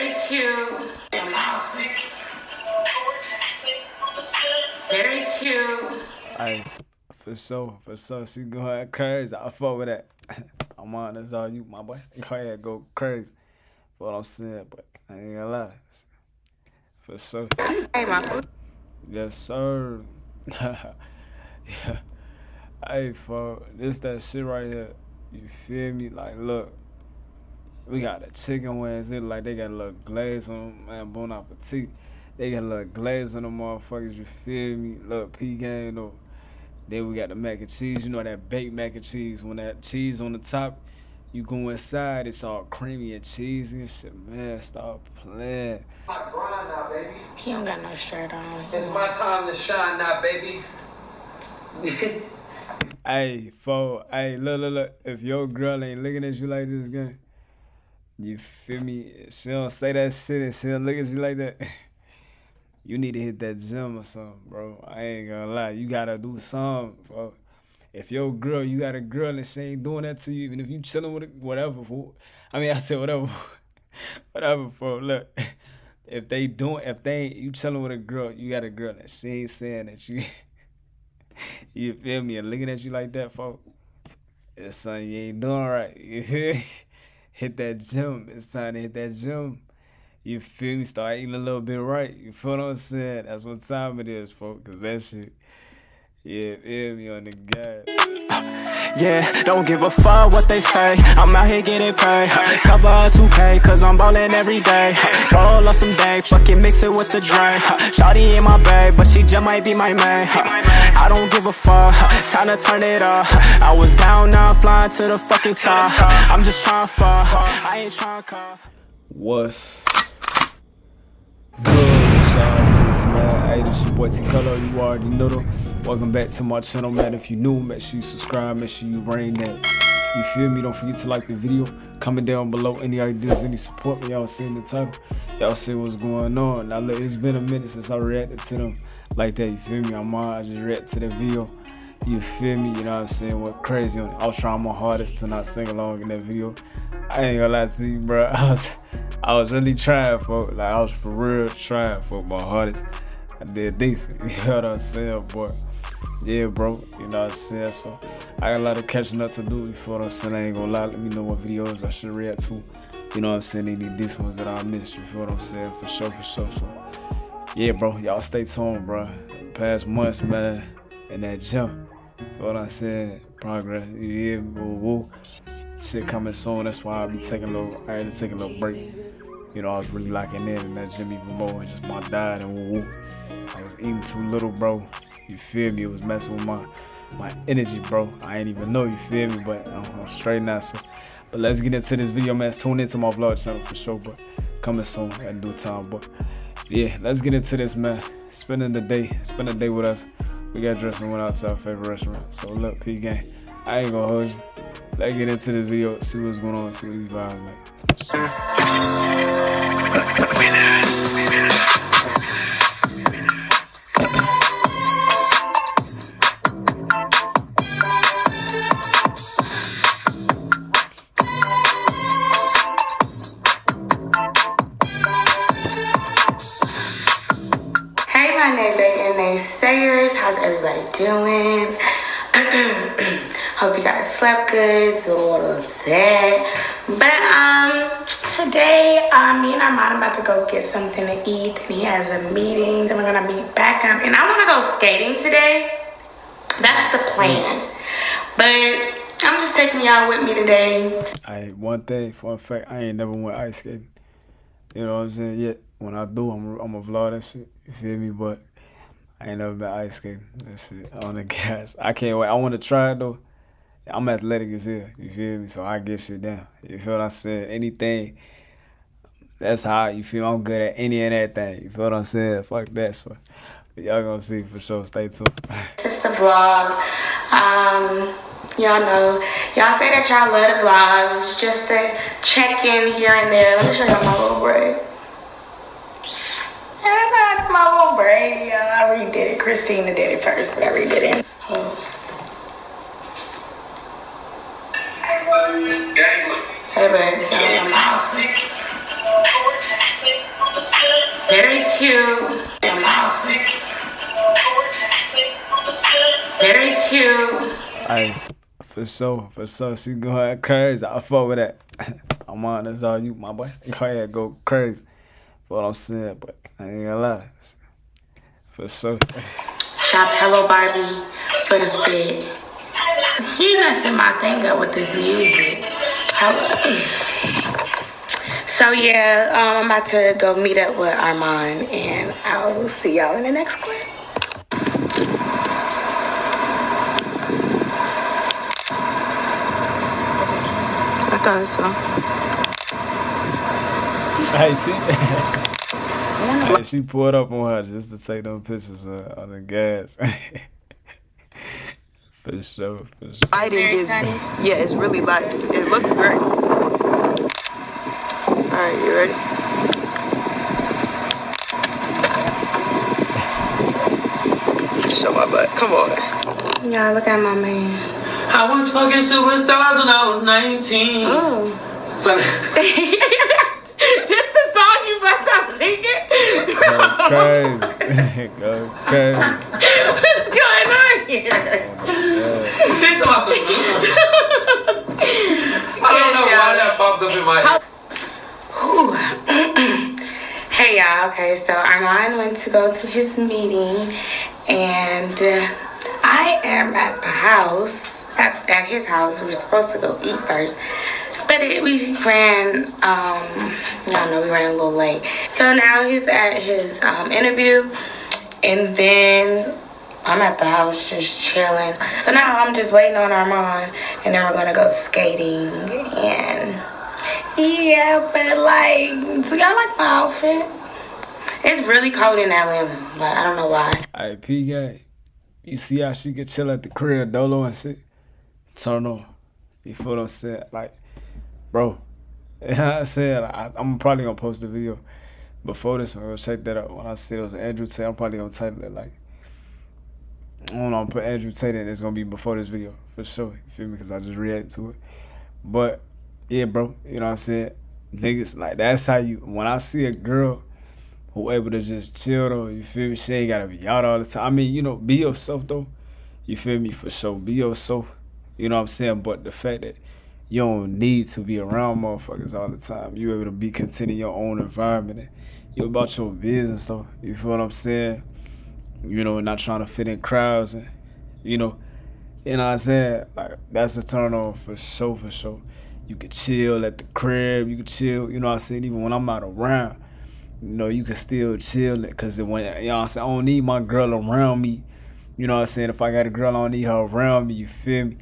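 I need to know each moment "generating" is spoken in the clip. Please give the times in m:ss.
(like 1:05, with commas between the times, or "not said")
not said.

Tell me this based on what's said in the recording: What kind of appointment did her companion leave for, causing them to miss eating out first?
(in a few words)
interview.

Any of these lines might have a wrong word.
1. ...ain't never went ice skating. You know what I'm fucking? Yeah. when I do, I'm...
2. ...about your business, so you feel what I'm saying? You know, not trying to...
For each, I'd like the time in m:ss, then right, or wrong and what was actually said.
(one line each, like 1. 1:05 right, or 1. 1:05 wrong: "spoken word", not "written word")
1. 4:12 wrong: "saying", not "fucking"
2. 7:45 right.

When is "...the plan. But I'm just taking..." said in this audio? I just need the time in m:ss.
4:06.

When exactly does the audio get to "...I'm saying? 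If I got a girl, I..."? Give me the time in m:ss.
8:05.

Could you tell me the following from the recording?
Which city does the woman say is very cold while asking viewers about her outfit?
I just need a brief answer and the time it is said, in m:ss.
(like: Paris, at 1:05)
Atlanta, at 7:02.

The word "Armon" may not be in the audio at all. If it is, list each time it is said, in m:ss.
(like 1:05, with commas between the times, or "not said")
5:30, 6:31, 6:53.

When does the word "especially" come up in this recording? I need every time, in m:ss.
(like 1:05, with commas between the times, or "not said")
not said.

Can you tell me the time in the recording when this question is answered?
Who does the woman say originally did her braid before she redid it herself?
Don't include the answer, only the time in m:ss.
4:49.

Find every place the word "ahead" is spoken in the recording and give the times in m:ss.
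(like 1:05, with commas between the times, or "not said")
0:12, 5:13.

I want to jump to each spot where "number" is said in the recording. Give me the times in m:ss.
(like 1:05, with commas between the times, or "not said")
not said.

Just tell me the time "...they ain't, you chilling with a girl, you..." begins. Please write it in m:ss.
1:17.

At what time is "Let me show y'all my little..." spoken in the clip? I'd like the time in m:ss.
4:43.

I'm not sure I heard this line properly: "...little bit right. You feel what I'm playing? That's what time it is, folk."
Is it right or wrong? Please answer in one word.
wrong.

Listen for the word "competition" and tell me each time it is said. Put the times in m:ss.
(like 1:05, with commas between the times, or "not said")
not said.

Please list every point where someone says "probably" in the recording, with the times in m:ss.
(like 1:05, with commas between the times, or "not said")
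7:13, 7:17.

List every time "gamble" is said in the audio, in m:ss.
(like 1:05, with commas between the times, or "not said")
not said.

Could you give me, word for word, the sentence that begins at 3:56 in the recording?
But um, today, um, me and Armand about to go get something to eat.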